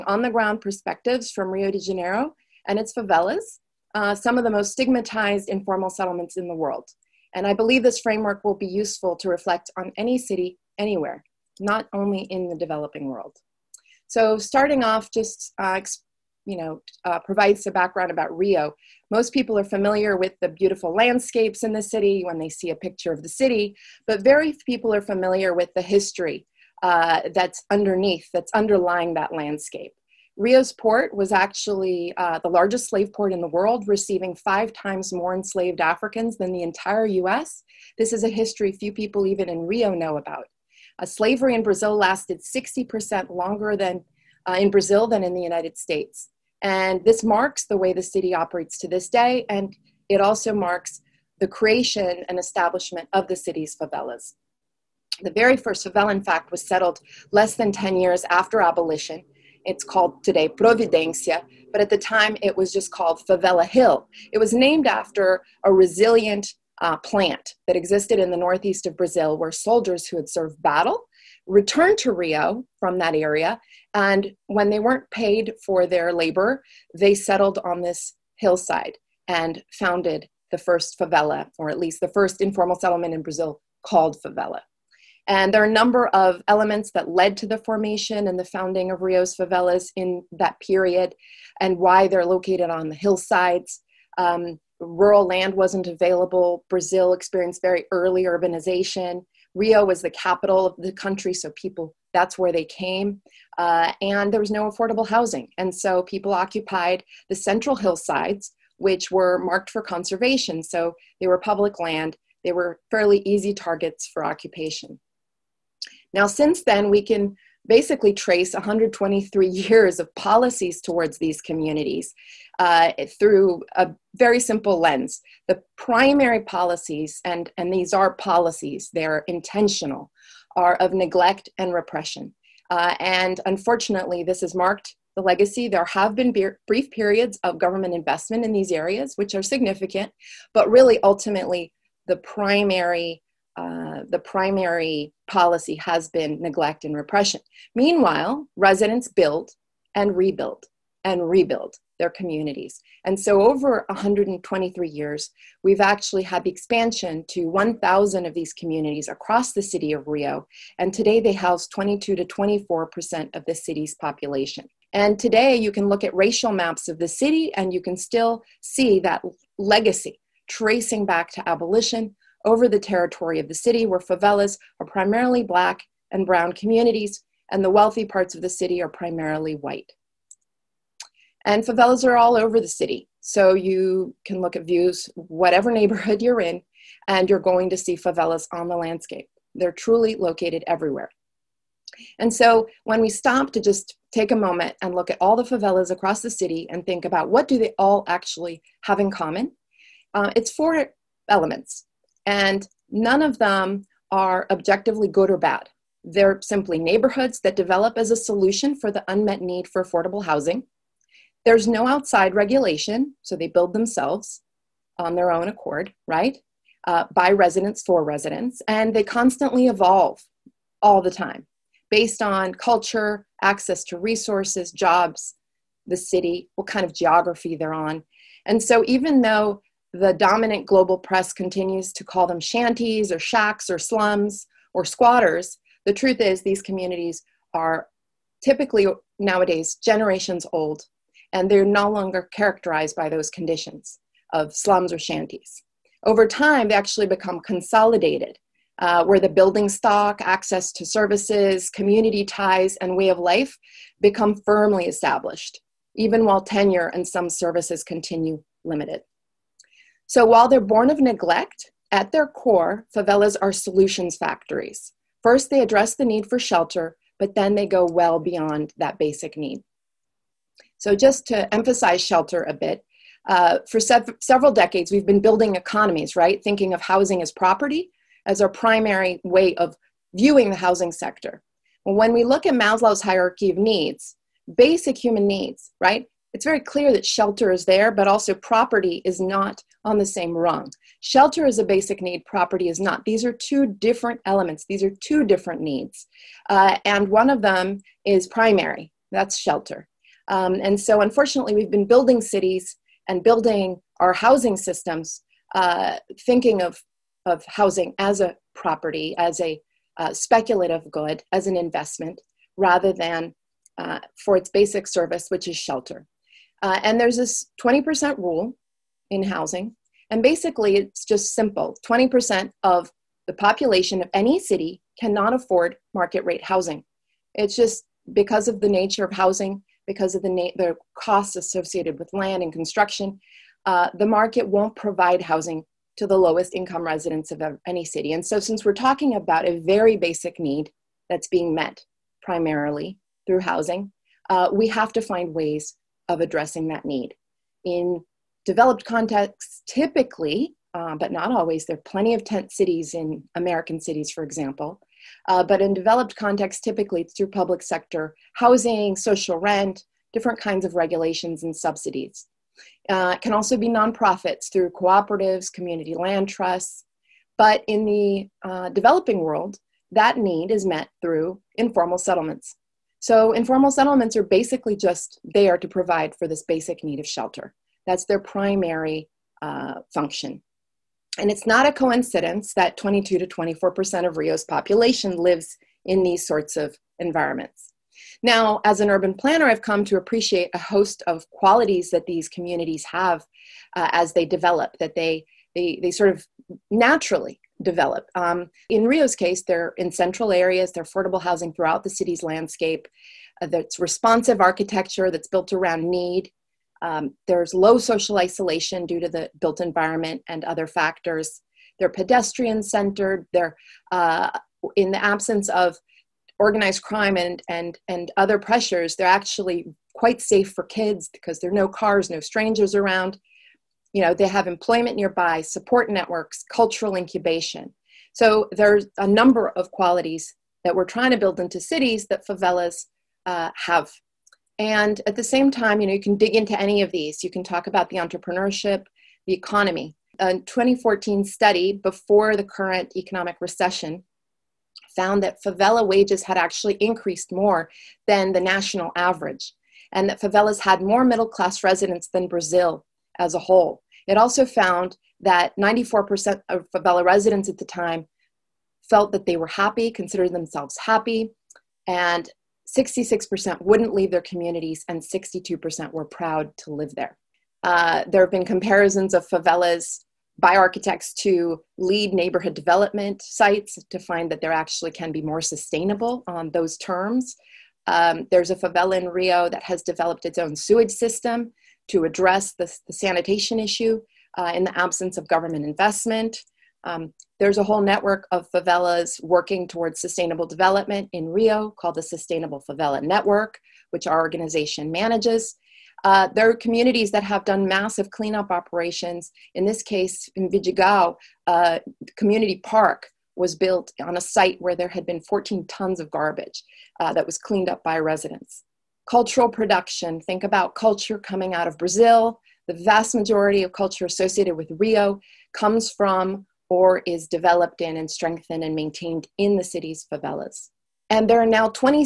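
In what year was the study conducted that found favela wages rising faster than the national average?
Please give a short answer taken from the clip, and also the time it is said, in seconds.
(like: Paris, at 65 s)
2014, at 440 s.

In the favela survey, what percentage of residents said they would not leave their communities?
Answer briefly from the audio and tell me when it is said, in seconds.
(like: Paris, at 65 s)
66%, at 462 s.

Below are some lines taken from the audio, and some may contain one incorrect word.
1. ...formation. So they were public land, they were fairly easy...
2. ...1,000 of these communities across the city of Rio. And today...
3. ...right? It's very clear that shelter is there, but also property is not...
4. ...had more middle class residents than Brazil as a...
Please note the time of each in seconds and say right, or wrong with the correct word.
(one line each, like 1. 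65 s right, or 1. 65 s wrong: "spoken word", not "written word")
1. 109 s wrong: "conservation", not "formation"
2. 157 s right
3. 285 s right
4. 450 s right.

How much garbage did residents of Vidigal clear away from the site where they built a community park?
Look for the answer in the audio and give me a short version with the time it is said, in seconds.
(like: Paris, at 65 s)
14 tons, at 505 s.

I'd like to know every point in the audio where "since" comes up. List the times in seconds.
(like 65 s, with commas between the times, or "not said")
116 s, 338 s.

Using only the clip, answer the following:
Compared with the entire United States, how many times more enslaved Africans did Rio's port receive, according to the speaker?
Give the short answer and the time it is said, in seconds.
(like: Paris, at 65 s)
5 times, at 34 s.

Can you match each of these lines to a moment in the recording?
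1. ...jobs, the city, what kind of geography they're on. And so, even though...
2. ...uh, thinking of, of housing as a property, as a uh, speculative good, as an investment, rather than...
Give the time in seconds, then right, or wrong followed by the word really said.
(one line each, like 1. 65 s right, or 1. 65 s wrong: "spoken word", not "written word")
1. 224 s right
2. 305 s right.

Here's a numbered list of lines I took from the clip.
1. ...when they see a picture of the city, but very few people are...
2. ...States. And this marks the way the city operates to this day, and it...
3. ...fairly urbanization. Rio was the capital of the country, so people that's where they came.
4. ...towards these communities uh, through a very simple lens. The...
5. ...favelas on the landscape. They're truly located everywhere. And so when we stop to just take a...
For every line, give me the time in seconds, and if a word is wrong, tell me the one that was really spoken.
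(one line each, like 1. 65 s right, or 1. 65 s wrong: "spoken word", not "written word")
1. 22 s right
2. 45 s right
3. 97 s wrong: "early", not "fairly"
4. 120 s right
5. 187 s right.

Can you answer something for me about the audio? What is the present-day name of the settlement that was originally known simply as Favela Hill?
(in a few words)
Providencia.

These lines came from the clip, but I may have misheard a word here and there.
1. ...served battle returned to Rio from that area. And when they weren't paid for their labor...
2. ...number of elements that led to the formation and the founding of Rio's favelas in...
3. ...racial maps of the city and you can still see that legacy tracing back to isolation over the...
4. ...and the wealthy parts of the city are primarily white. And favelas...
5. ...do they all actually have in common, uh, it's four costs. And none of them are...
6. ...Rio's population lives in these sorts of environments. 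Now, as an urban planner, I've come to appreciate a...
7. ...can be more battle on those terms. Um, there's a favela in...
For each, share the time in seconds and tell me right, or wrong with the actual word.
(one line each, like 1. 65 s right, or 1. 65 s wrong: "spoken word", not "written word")
1. 70 s right
2. 85 s right
3. 166 s wrong: "abolition", not "isolation"
4. 177 s right
5. 197 s wrong: "elements", not "costs"
6. 384 s right
7. 474 s wrong: "sustainable", not "battle".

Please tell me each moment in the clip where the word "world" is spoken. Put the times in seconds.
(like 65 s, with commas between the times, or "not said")
6 s, 13 s, 33 s, 369 s.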